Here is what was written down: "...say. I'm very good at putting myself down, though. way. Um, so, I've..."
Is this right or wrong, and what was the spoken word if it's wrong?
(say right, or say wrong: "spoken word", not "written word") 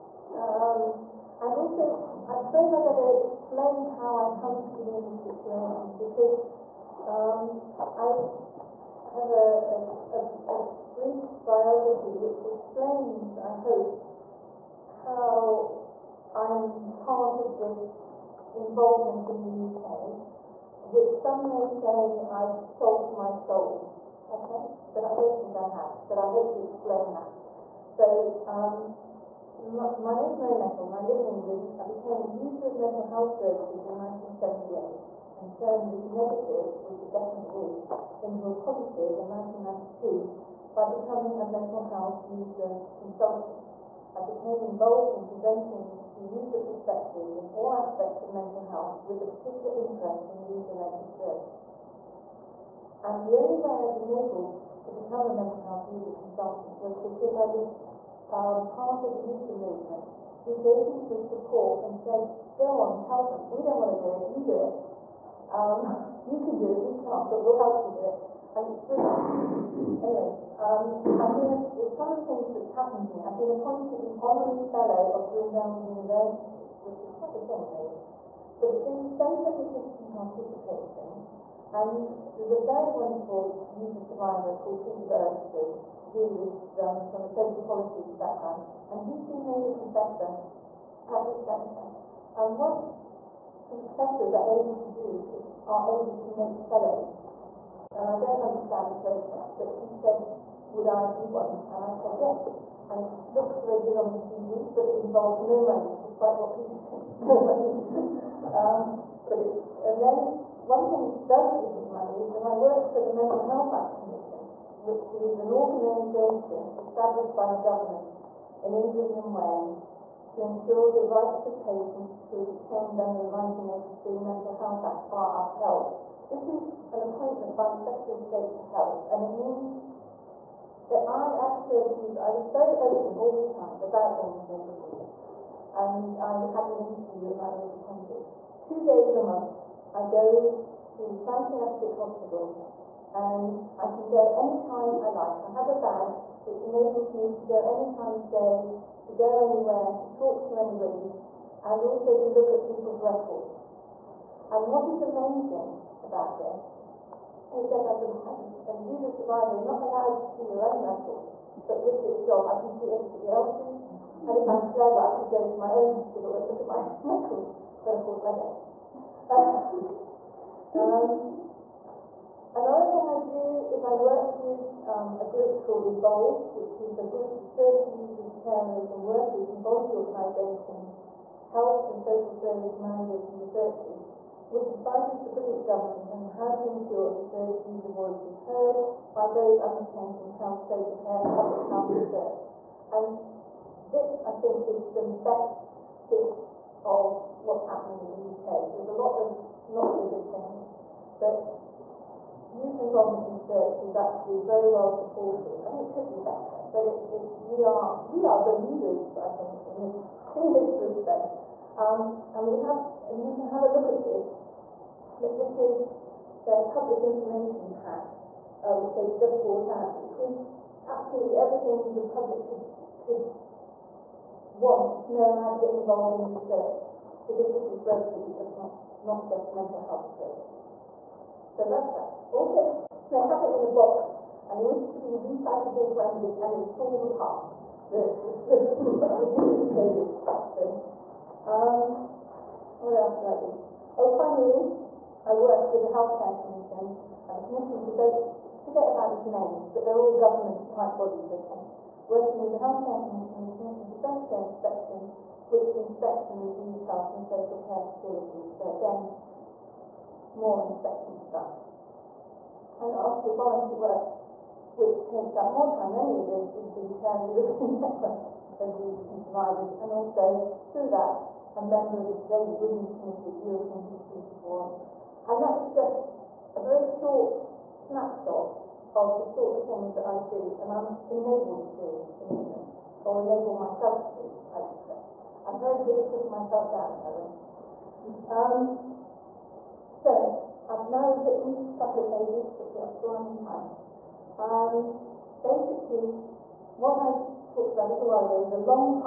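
right.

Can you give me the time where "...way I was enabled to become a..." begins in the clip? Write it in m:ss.
0:53.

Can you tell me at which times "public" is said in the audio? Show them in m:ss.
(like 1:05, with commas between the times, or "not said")
3:11, 3:36, 3:42.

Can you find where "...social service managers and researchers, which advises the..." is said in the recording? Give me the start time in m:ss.
3:02.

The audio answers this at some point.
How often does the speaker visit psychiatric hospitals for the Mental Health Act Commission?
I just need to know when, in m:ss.
2:18.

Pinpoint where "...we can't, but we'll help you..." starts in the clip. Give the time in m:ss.
1:06.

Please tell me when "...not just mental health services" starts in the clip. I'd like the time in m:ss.
3:49.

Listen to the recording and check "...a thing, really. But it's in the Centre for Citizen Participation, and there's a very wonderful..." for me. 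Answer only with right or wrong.
right.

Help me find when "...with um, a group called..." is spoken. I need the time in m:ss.
2:54.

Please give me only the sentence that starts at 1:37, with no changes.
And I don't understand the process, but he said, would I be one?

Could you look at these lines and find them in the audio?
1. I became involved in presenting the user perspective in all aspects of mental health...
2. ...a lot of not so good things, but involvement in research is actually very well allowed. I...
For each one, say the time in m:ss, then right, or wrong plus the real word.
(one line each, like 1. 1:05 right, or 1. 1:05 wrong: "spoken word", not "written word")
1. 0:44 right
2. 3:18 wrong: "supported", not "allowed".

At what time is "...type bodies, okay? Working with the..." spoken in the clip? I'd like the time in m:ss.
4:10.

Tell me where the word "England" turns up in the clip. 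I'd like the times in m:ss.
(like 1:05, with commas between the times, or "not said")
0:31, 1:58, 4:42.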